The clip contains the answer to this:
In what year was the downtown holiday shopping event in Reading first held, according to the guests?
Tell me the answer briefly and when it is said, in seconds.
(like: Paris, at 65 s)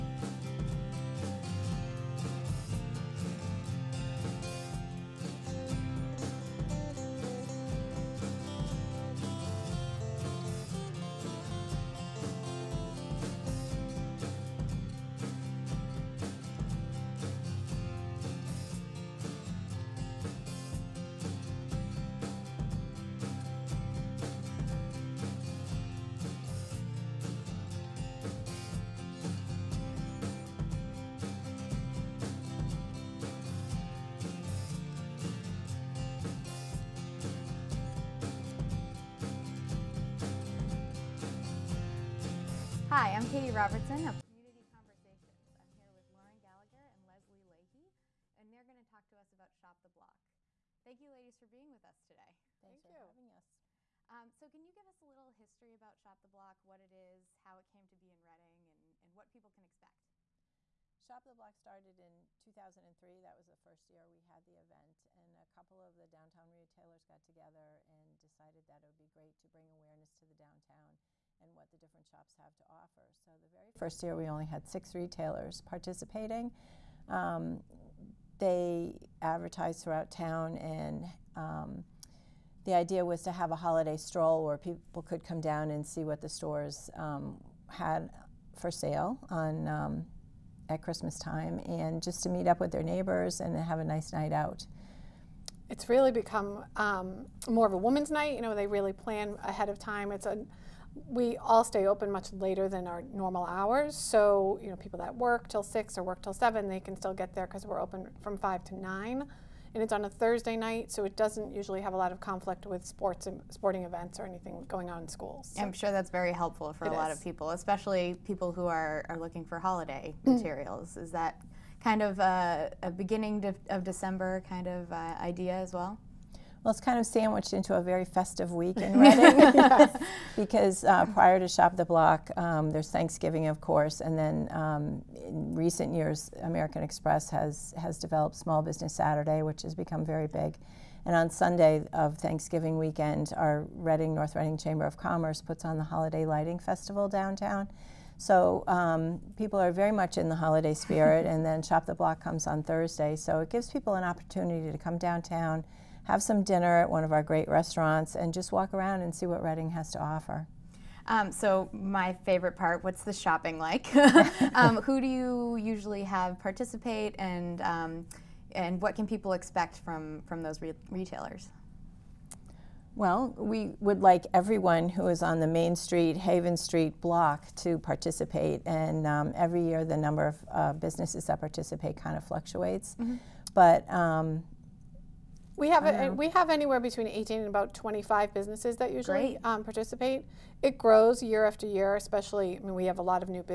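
2003, at 62 s.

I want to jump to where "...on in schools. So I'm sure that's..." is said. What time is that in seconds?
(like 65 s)
114 s.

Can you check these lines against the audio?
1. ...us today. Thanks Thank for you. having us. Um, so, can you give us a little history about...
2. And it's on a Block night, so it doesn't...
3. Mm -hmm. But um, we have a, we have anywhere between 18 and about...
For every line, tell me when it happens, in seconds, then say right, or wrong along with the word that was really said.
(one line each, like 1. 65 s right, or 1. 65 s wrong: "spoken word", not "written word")
1. 51 s right
2. 109 s wrong: "Thursday", not "Block"
3. 182 s right.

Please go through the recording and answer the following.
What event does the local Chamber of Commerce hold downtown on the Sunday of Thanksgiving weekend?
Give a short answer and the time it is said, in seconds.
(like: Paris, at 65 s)
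Holiday Lighting Festival, at 145 s.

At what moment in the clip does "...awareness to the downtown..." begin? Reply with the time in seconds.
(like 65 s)
69 s.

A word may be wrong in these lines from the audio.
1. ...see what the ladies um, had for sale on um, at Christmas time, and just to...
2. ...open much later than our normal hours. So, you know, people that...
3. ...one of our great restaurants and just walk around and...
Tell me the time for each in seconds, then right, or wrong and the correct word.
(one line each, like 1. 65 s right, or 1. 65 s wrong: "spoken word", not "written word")
1. 85 s wrong: "stores", not "ladies"
2. 101 s right
3. 156 s right.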